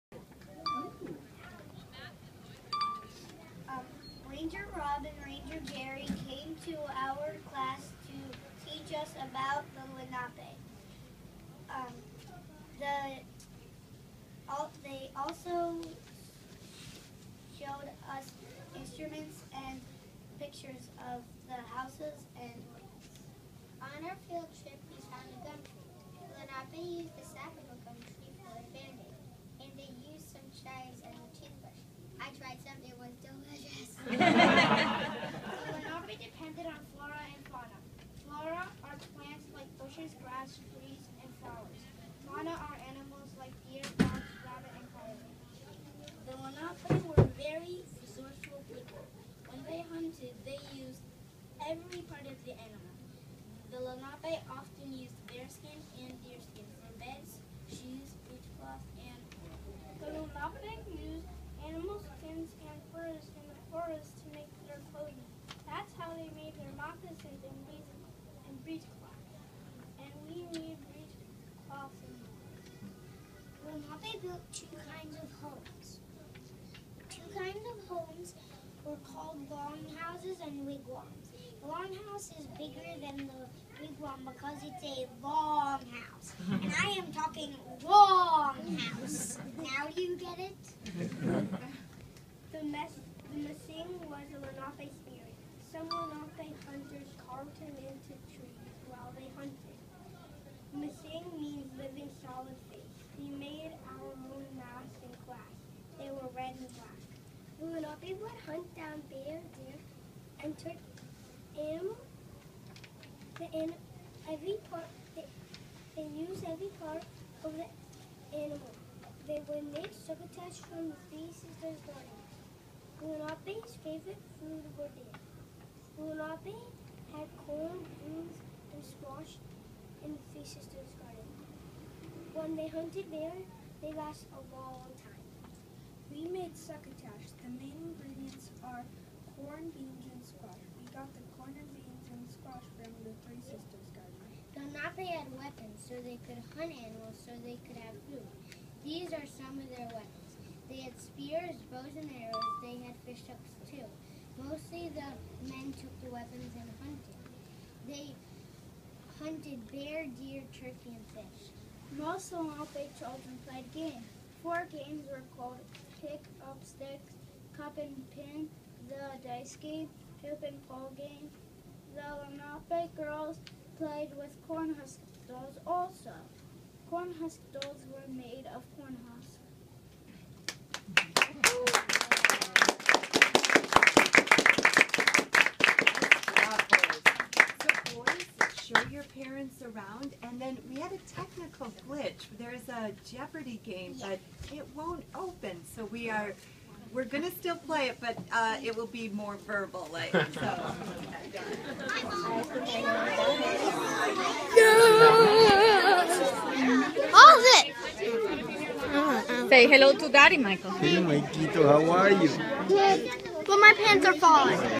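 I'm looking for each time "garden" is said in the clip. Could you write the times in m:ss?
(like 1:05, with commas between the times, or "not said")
2:11, 2:23.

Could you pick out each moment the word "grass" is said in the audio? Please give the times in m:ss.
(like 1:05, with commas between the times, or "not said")
0:40.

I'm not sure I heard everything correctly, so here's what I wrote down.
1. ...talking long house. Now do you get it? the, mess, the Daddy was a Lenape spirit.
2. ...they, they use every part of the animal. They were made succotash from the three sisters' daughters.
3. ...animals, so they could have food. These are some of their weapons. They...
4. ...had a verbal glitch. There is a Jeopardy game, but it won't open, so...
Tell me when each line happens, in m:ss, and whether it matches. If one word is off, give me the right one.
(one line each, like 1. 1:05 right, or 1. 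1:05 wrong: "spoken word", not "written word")
1. 1:27 wrong: "Mesingw", not "Daddy"
2. 1:55 right
3. 2:26 right
4. 3:10 wrong: "technical", not "verbal".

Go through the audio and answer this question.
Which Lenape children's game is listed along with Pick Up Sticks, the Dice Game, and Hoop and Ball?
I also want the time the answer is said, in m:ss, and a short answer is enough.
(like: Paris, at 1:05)
Cup and Pin, at 2:47.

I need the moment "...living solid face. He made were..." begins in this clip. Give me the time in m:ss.
1:41.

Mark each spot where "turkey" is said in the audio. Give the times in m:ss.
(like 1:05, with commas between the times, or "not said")
1:50, 2:40.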